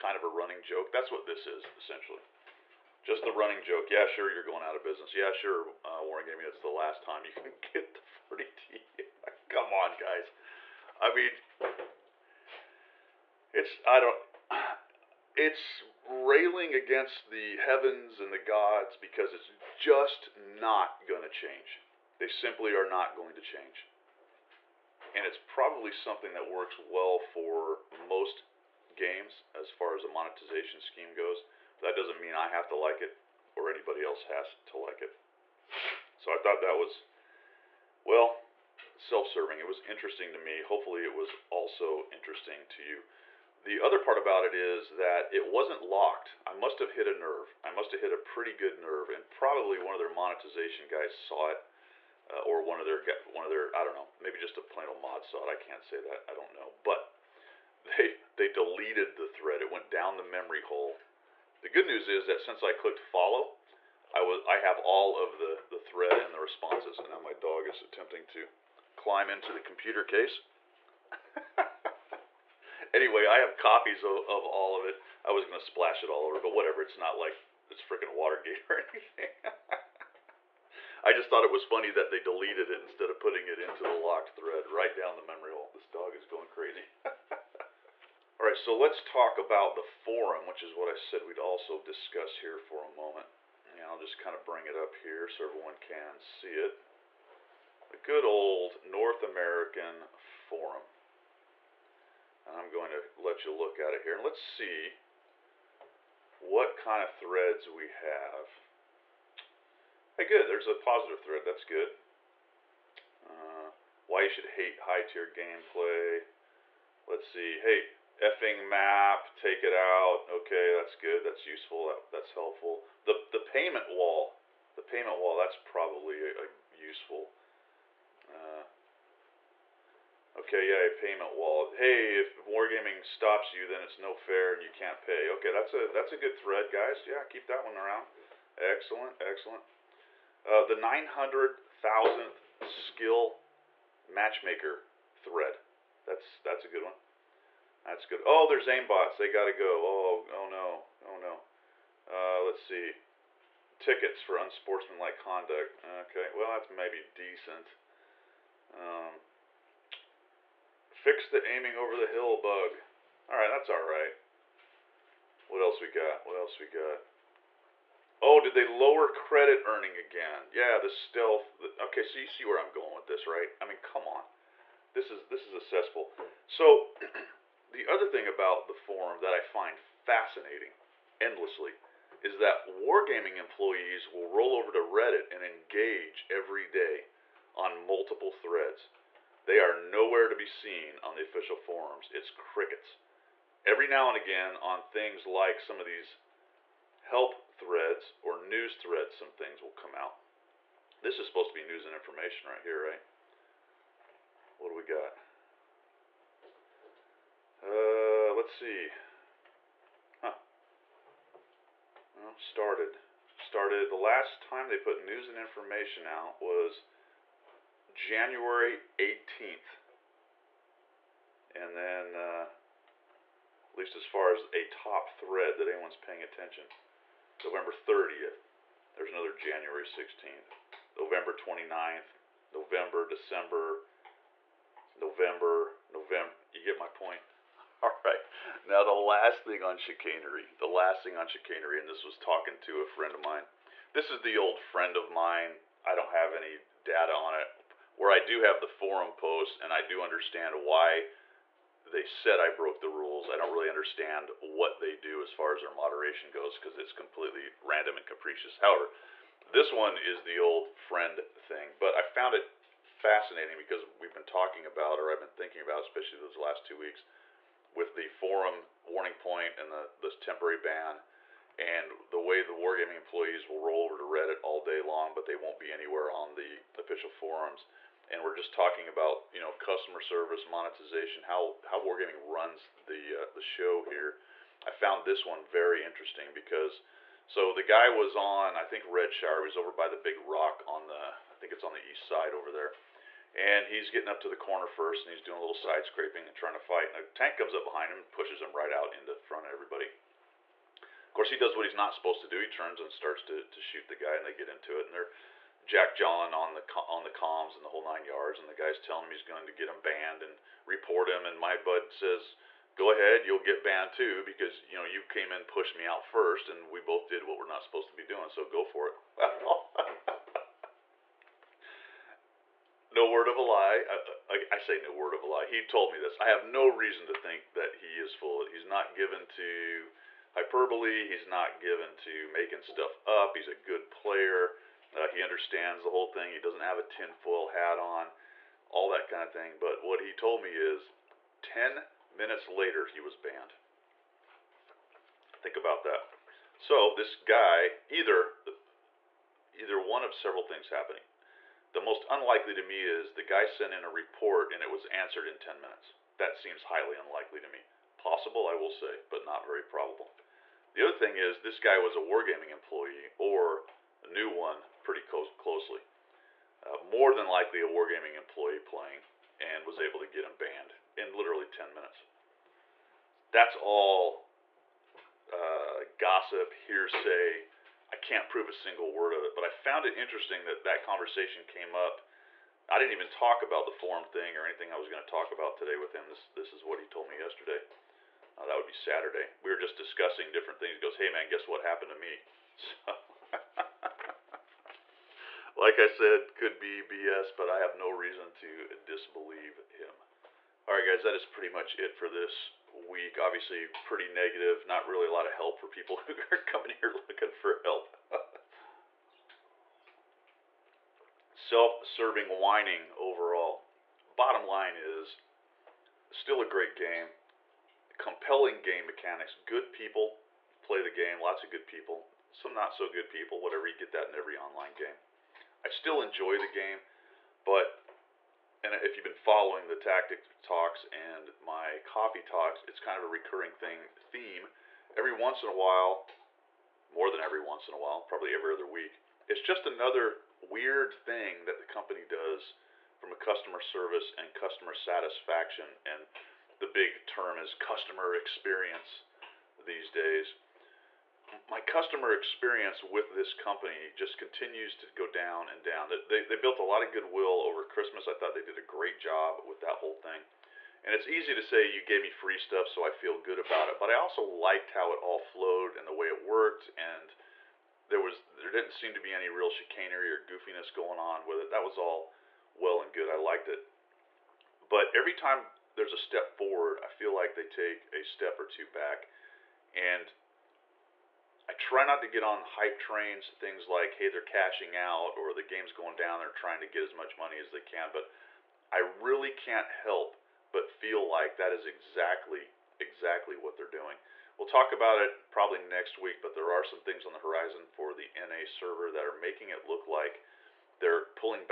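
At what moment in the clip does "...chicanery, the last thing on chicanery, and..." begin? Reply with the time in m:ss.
3:59.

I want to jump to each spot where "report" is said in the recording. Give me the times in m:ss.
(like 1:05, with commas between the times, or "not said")
5:10, 5:53.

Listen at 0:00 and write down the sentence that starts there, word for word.
That's what this is essentially, just the running joke.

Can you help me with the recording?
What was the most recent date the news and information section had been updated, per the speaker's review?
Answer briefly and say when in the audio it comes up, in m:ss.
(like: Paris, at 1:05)
January 18th, at 3:37.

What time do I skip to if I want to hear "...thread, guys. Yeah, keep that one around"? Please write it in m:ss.
2:16.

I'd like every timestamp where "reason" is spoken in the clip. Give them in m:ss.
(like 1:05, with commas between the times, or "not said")
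5:26, 6:37.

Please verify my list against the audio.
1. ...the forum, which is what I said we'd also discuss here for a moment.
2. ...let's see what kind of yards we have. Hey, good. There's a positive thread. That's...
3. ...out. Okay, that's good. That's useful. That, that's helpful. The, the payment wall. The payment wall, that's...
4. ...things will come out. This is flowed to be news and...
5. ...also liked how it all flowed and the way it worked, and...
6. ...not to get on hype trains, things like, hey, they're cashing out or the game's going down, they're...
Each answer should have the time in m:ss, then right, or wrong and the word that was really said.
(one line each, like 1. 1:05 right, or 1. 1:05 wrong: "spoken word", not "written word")
1. 1:29 right
2. 1:44 wrong: "threads", not "yards"
3. 1:59 right
4. 3:19 wrong: "supposed", not "flowed"
5. 7:43 right
6. 8:01 right.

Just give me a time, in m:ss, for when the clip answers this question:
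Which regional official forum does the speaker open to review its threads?
1:38.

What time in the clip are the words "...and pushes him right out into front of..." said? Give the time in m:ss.
4:57.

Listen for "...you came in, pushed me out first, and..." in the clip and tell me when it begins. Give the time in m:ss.
5:14.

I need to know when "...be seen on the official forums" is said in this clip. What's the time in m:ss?
3:10.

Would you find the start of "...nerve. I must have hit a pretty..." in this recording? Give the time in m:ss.
0:47.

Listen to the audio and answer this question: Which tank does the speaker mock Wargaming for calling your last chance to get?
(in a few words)
40T.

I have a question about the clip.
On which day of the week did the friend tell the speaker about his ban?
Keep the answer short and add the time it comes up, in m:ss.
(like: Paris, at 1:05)
Saturday, at 6:28.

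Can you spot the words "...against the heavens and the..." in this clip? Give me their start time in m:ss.
0:16.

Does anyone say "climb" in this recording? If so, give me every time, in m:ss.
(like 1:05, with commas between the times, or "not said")
1:08.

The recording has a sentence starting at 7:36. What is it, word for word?
They, they built a lot of goodwill over Christmas.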